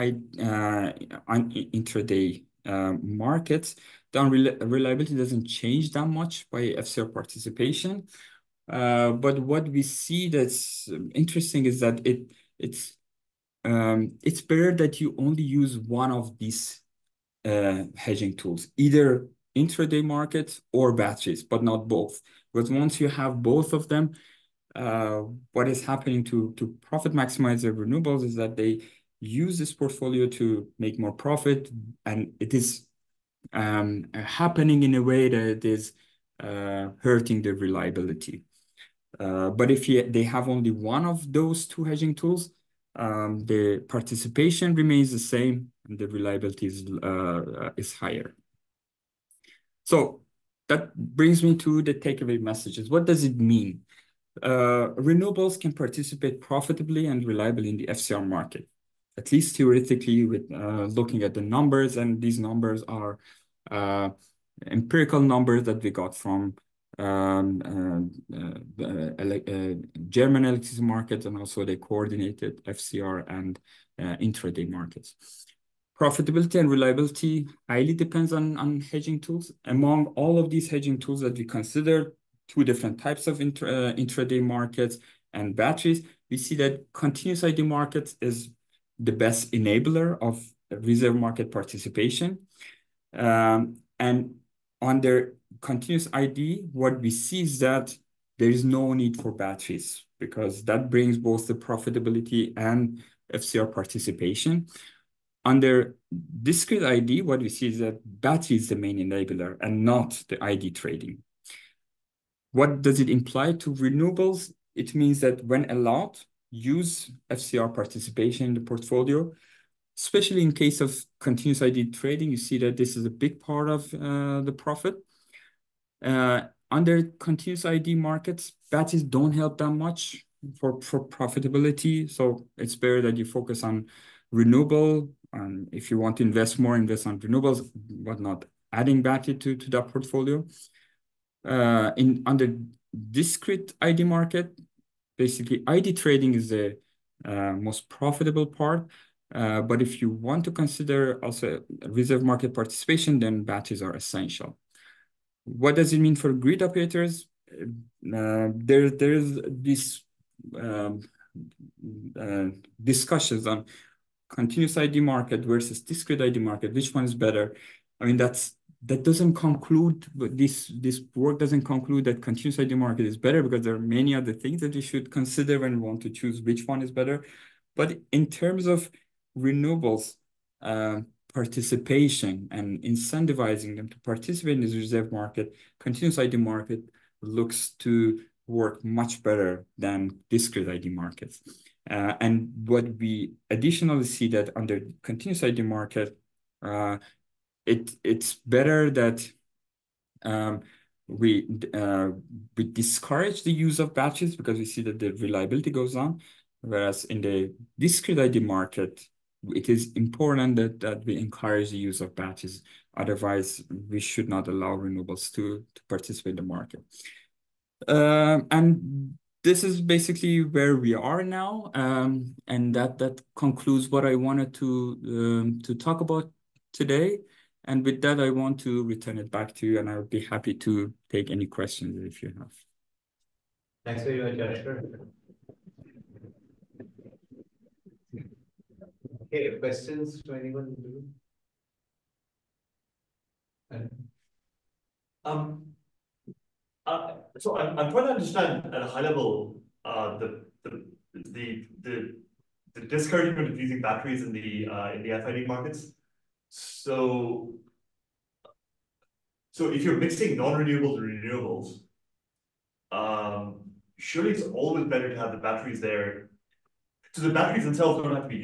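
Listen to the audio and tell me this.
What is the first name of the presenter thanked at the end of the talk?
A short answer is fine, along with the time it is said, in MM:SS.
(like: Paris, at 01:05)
Yashar, at 03:54.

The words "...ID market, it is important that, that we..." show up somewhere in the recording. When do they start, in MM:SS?
03:28.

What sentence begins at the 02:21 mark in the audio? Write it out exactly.
Uh, under discrete ID market, basically ID trading is the uh, most profitable part.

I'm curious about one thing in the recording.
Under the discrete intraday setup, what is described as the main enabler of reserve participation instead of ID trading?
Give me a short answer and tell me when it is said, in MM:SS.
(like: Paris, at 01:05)
Battery, at 01:48.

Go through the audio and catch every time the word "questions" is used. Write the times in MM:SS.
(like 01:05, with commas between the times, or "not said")
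03:51, 03:59.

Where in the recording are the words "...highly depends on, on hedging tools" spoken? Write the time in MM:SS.
01:17.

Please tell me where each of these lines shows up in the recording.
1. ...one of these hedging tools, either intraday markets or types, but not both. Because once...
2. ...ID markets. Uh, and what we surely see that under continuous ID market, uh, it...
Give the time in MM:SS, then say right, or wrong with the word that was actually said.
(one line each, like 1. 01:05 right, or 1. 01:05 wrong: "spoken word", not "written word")
1. 00:15 wrong: "batches", not "types"
2. 03:10 wrong: "additionally", not "surely".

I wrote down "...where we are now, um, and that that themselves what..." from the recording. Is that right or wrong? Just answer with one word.
wrong.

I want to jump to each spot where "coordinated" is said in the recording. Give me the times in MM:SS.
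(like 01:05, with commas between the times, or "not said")
01:11.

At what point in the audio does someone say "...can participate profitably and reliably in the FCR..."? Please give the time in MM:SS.
00:55.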